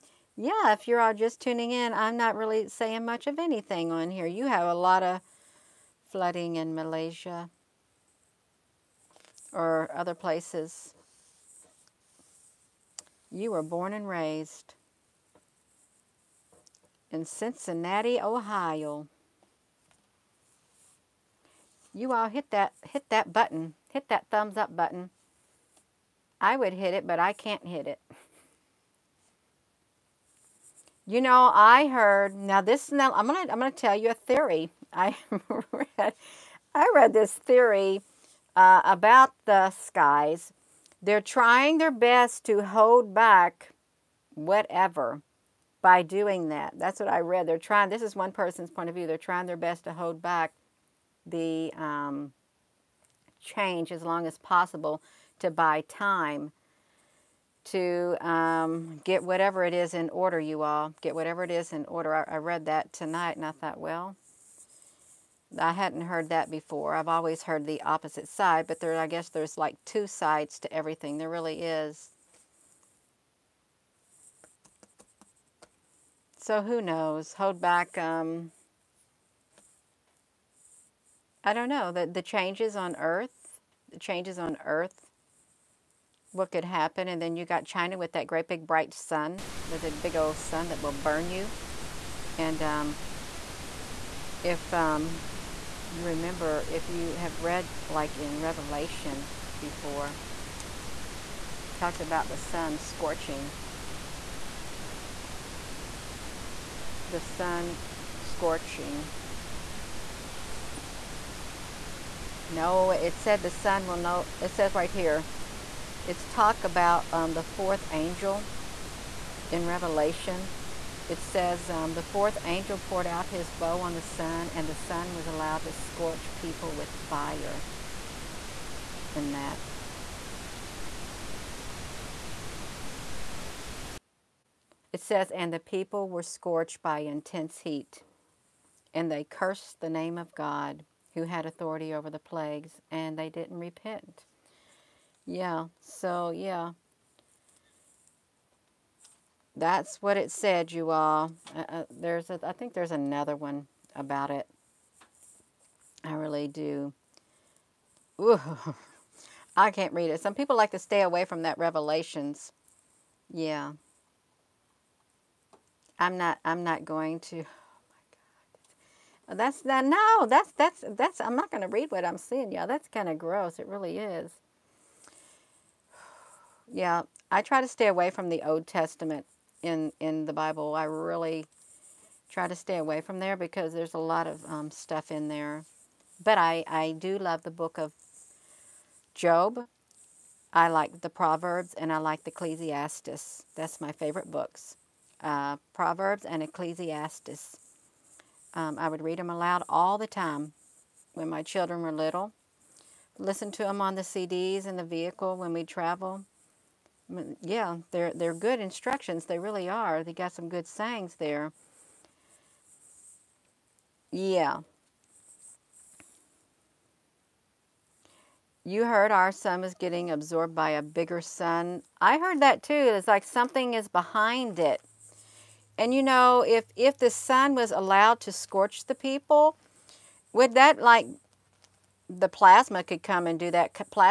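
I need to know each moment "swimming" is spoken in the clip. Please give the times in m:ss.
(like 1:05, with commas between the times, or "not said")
not said.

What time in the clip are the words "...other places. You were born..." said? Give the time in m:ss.
0:09.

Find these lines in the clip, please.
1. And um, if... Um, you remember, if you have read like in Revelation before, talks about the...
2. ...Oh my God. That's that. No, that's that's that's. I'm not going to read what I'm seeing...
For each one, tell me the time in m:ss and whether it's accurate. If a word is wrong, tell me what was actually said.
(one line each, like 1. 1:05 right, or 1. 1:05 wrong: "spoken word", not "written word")
1. 1:32 right
2. 2:49 right.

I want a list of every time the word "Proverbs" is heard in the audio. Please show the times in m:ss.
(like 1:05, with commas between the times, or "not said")
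3:11, 3:15.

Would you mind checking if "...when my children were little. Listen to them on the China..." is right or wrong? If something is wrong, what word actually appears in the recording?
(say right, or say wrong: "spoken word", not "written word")
wrong: "CDs", not "China".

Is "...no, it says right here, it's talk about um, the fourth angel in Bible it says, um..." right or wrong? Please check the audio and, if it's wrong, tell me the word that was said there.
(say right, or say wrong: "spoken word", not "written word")
wrong: "Revelation", not "Bible".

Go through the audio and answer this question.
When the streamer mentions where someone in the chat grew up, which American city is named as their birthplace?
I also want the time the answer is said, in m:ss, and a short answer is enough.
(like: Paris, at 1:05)
Cincinnati, Ohio, at 0:17.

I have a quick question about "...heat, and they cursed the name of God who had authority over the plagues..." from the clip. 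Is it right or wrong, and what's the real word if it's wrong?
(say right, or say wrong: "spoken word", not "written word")
right.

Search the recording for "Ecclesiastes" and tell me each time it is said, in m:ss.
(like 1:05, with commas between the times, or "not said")
3:12, 3:16.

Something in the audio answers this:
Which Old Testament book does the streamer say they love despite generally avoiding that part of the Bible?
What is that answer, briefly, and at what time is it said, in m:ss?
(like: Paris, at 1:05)
Job, at 3:09.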